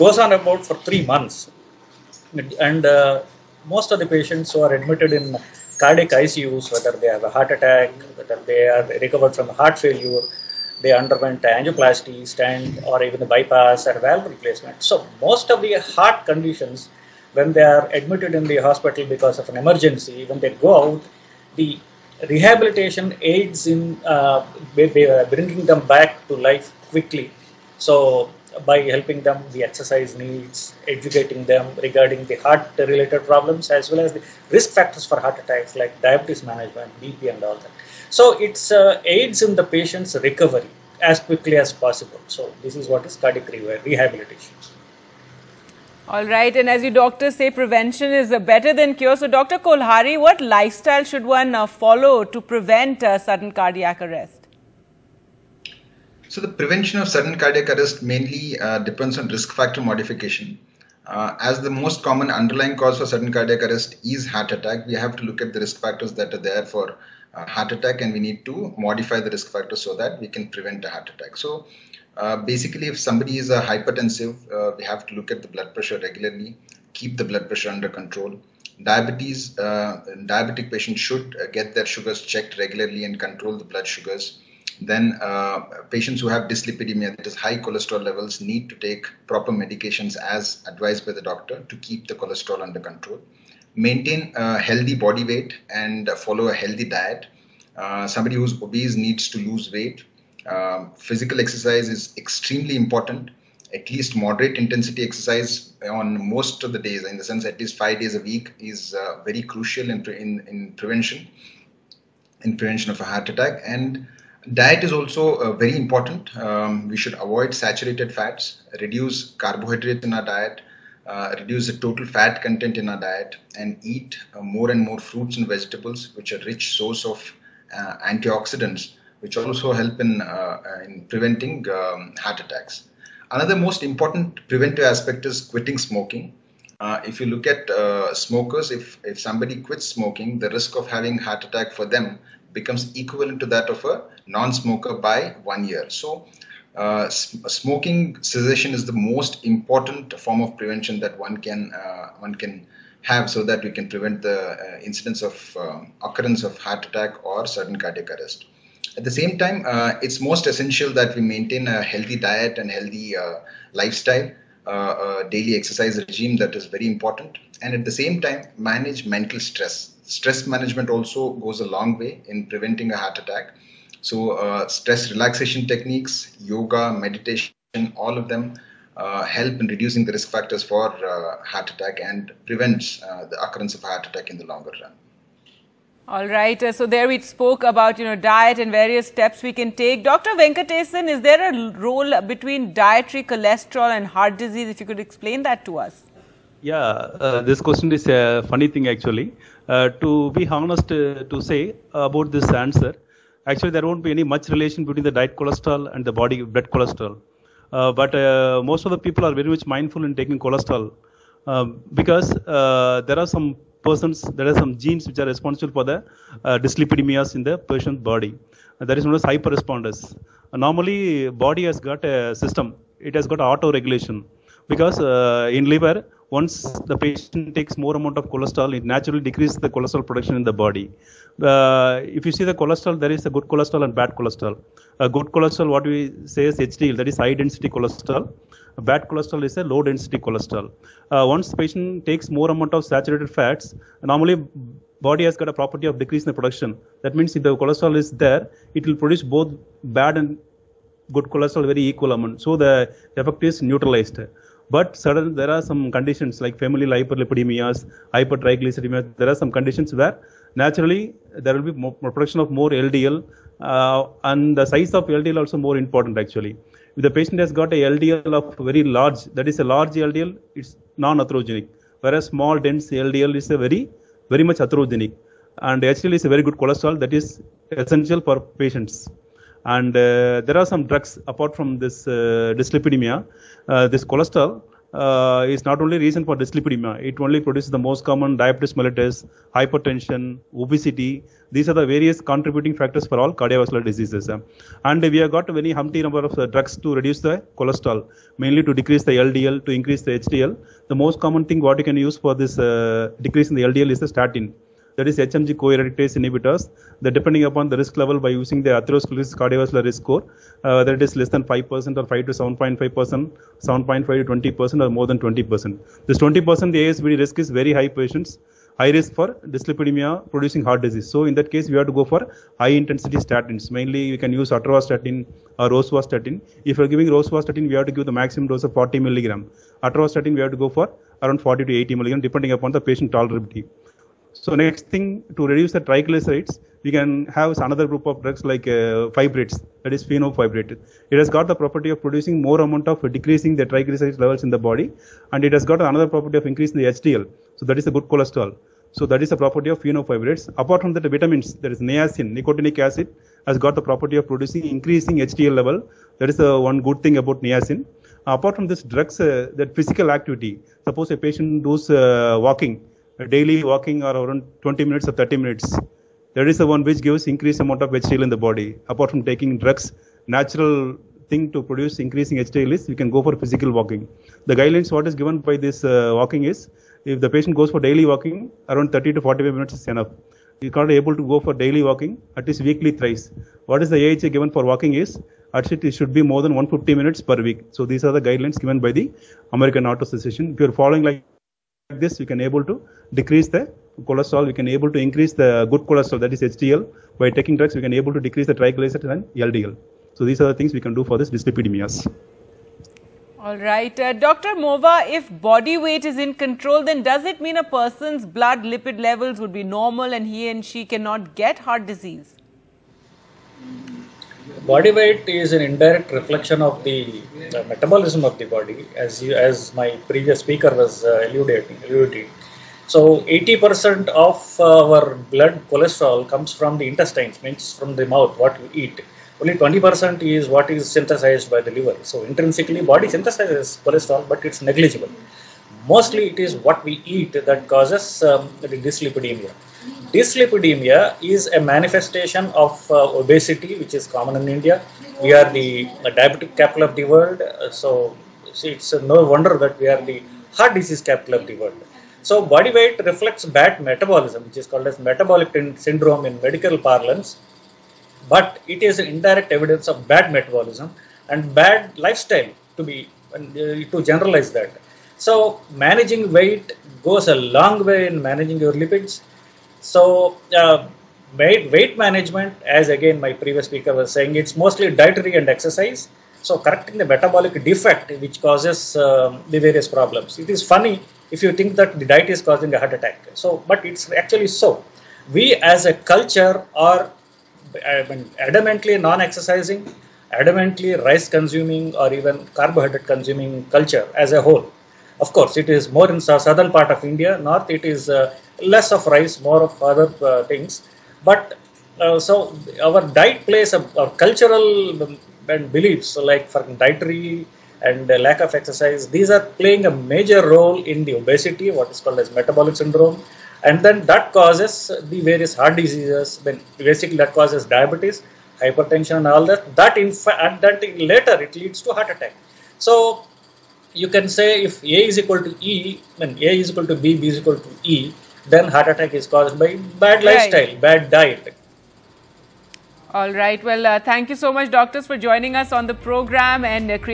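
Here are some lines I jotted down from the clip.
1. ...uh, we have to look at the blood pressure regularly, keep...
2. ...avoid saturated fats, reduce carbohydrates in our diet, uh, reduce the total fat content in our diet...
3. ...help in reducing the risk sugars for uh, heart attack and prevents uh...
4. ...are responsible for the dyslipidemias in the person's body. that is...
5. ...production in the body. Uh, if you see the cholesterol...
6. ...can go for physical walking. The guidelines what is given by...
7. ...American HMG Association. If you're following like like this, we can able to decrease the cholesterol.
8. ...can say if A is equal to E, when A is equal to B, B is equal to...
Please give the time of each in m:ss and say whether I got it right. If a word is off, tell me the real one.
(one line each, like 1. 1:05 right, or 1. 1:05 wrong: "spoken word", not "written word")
1. 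1:14 right
2. 1:57 right
3. 2:59 wrong: "factors", not "sugars"
4. 3:35 right
5. 3:50 right
6. 6:12 right
7. 6:29 wrong: "Auto", not "HMG"
8. 8:44 right.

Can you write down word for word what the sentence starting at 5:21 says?
So in that case, we have to go for high intensity statins.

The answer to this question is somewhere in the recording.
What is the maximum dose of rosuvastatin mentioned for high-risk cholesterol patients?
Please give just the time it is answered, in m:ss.
5:28.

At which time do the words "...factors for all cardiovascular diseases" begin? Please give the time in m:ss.
4:52.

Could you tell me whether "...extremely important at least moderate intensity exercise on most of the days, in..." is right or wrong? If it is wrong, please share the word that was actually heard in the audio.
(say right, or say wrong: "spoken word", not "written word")
right.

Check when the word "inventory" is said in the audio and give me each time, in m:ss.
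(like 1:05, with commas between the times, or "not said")
not said.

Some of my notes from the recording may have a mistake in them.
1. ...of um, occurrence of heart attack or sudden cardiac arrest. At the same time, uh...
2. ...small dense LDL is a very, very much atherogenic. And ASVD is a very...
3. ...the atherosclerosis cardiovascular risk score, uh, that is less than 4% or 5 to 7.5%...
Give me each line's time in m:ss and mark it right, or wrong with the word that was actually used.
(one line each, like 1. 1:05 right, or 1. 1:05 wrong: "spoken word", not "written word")
1. 2:35 right
2. 4:32 wrong: "HDL", not "ASVD"
3. 5:08 wrong: "5", not "4".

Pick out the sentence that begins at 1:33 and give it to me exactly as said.
Maintain a uh, healthy body weight and uh, follow a healthy diet.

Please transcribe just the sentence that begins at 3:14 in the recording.
If you could explain that to us.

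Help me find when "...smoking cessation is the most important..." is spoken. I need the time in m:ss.
2:27.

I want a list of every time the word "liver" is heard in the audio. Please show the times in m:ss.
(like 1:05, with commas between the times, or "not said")
3:45, 7:11.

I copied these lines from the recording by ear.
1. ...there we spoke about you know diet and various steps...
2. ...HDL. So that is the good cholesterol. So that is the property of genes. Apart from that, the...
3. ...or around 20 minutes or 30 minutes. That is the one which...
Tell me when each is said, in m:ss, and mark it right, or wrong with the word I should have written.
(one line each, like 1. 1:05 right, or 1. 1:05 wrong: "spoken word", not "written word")
1. 3:06 right
2. 5:46 wrong: "fenofibrates", not "genes"
3. 6:04 right.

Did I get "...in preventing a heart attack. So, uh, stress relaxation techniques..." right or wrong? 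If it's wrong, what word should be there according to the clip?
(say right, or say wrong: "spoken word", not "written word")
right.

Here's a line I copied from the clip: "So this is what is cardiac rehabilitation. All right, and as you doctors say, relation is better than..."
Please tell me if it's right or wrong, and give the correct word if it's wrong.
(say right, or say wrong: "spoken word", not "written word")
wrong: "prevention", not "relation".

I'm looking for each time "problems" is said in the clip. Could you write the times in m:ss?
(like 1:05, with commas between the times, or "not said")
0:33, 7:59.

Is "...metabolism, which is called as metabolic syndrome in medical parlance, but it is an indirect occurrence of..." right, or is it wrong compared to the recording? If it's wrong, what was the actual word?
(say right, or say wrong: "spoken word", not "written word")
wrong: "evidence", not "occurrence".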